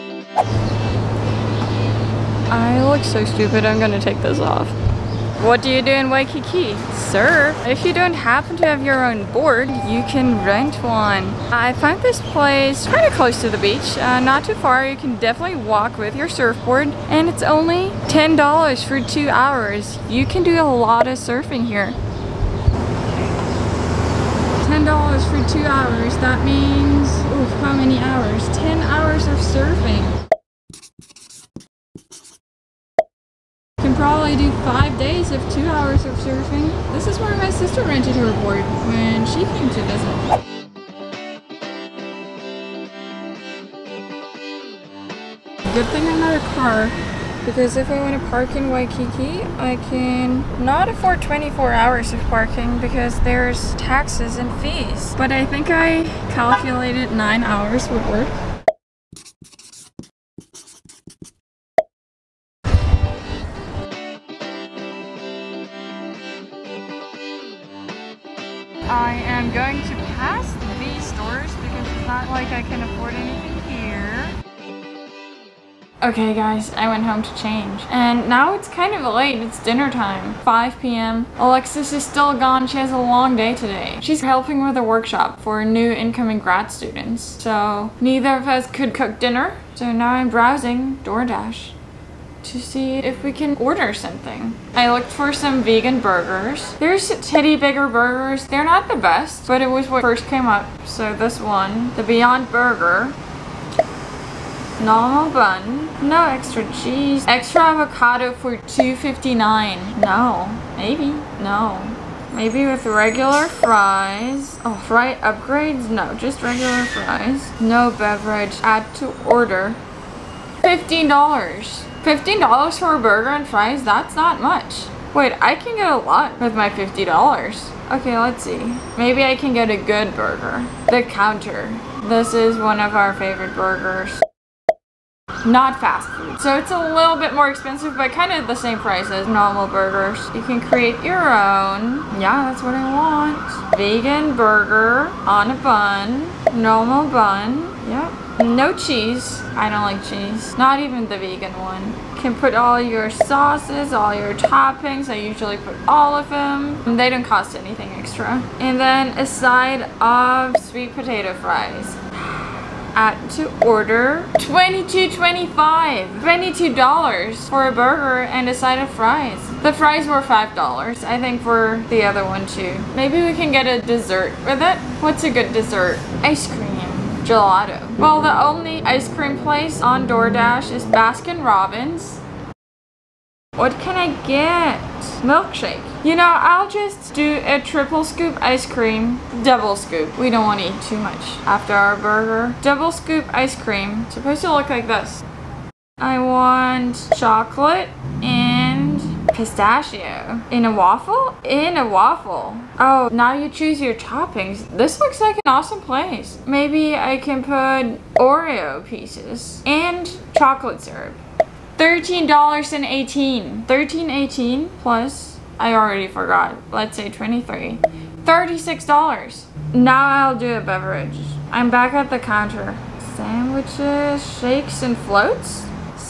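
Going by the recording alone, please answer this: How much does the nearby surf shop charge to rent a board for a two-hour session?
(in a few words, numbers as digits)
$10.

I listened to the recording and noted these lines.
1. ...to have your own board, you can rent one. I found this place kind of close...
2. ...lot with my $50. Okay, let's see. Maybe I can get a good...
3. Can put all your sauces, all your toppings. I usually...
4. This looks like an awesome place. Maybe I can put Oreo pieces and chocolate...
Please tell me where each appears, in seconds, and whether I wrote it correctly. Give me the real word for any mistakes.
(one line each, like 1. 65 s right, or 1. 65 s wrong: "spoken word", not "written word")
1. 8 s right
2. 125 s right
3. 152 s right
4. 204 s right.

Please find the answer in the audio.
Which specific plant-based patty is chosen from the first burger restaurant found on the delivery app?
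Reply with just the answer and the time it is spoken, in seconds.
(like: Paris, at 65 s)
Beyond Burger, at 101 s.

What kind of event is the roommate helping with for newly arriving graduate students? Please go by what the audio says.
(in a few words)
workshop.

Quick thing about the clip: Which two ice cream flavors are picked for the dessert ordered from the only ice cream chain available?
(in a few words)
chocolate and pistachio.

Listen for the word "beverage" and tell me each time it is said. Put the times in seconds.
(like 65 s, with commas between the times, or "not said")
117 s, 220 s.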